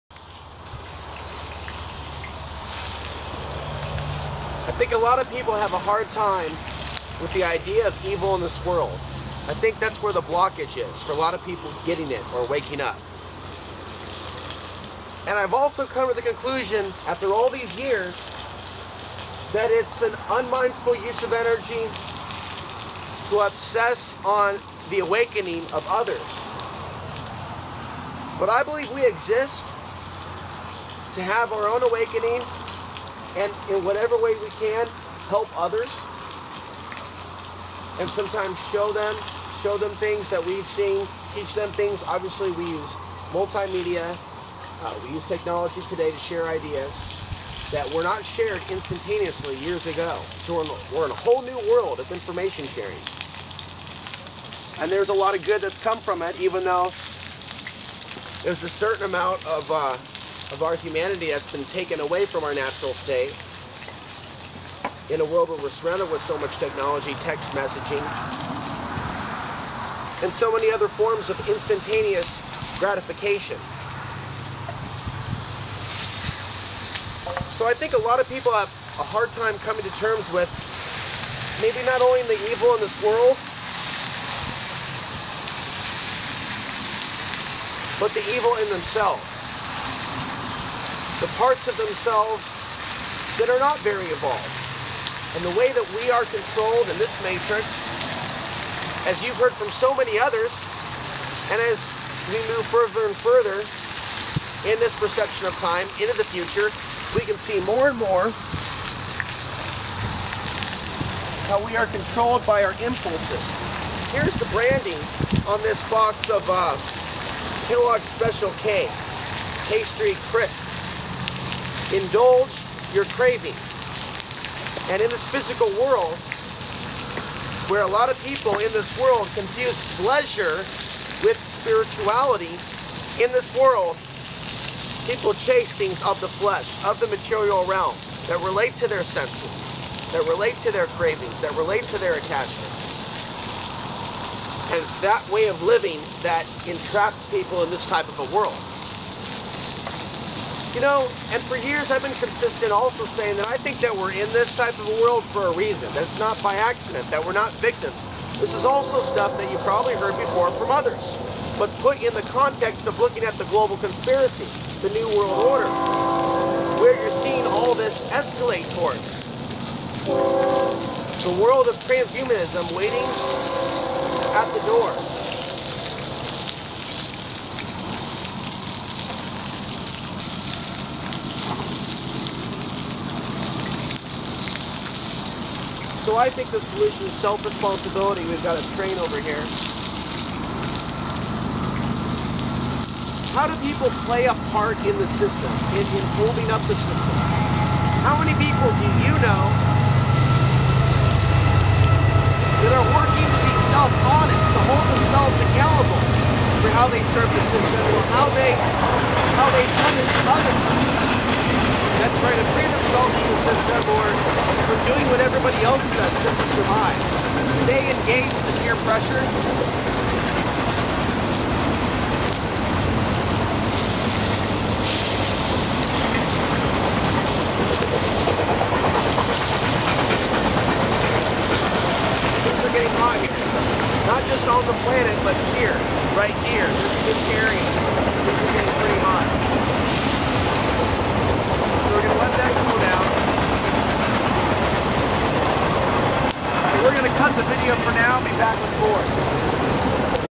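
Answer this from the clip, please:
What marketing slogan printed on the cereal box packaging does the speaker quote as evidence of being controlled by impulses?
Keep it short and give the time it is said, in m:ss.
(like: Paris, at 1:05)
Indulge your cravings, at 2:01.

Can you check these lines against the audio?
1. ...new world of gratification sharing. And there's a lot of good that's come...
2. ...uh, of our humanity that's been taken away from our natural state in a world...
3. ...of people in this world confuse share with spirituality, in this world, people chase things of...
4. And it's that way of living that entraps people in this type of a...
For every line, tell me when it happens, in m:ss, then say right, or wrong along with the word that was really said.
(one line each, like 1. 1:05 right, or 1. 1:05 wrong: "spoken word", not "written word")
1. 0:51 wrong: "information", not "gratification"
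2. 0:59 right
3. 2:08 wrong: "pleasure", not "share"
4. 2:24 right.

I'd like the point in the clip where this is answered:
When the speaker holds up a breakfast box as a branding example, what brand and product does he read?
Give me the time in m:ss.
1:57.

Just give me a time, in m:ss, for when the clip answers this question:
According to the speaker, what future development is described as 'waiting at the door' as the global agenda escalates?
2:51.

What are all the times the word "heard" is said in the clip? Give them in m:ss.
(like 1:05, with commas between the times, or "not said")
1:39, 2:39.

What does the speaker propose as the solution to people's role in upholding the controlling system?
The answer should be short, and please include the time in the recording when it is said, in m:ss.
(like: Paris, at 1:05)
Self-responsibility, at 3:07.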